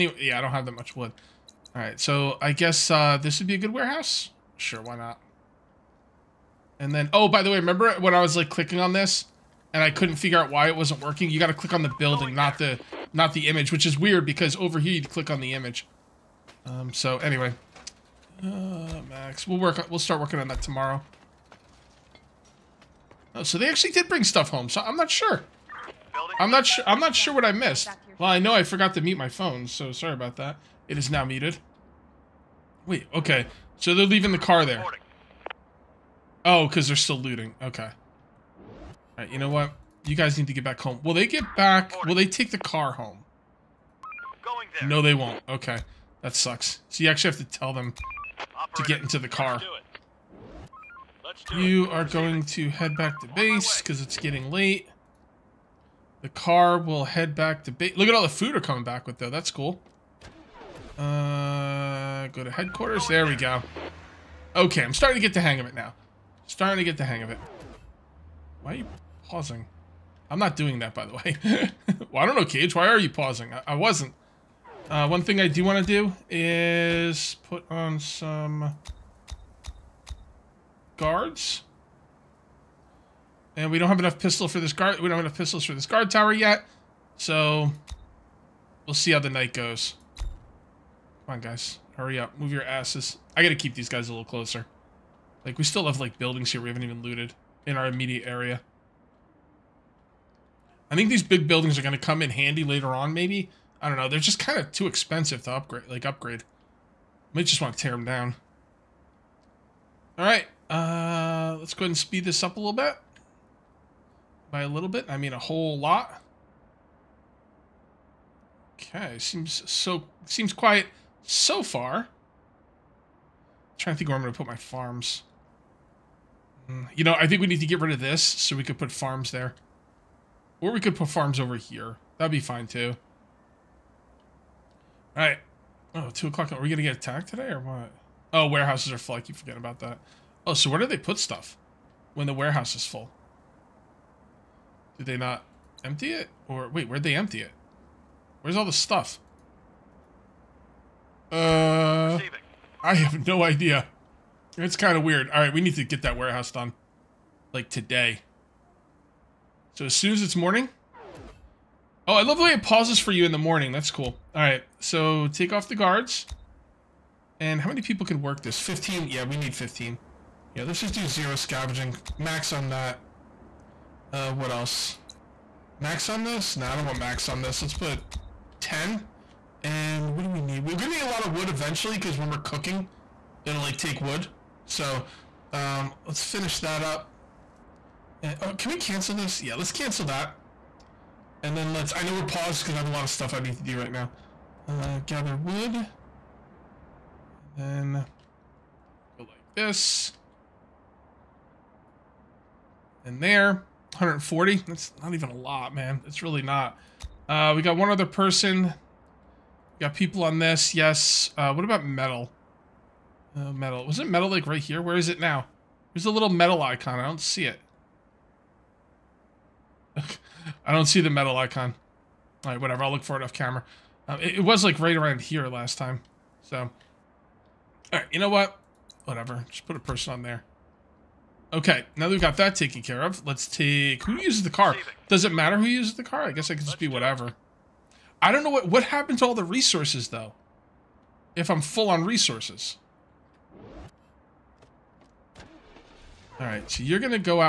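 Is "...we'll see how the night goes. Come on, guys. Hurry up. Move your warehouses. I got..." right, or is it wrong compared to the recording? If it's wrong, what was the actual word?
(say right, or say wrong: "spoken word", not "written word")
wrong: "asses", not "warehouses".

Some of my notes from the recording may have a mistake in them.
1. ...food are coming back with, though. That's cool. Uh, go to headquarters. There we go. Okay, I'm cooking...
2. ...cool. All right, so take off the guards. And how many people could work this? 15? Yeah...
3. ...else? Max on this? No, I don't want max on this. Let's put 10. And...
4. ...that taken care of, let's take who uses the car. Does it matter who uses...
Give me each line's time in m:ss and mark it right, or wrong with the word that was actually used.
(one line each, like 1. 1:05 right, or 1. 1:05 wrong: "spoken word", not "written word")
1. 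0:58 wrong: "starting", not "cooking"
2. 2:43 right
3. 2:54 right
4. 3:52 right.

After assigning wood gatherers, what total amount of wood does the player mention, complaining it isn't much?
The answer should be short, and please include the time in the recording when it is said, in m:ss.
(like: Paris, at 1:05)
140, at 3:23.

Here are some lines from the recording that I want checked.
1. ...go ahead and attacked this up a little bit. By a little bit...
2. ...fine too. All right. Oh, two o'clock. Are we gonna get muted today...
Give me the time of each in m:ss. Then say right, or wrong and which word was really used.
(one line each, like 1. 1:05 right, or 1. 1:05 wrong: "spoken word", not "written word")
1. 1:51 wrong: "speed", not "attacked"
2. 2:12 wrong: "attacked", not "muted".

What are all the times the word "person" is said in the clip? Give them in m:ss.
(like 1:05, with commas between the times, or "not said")
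3:28, 3:49.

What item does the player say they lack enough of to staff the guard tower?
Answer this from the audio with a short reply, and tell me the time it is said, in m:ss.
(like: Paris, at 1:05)
pistols, at 1:25.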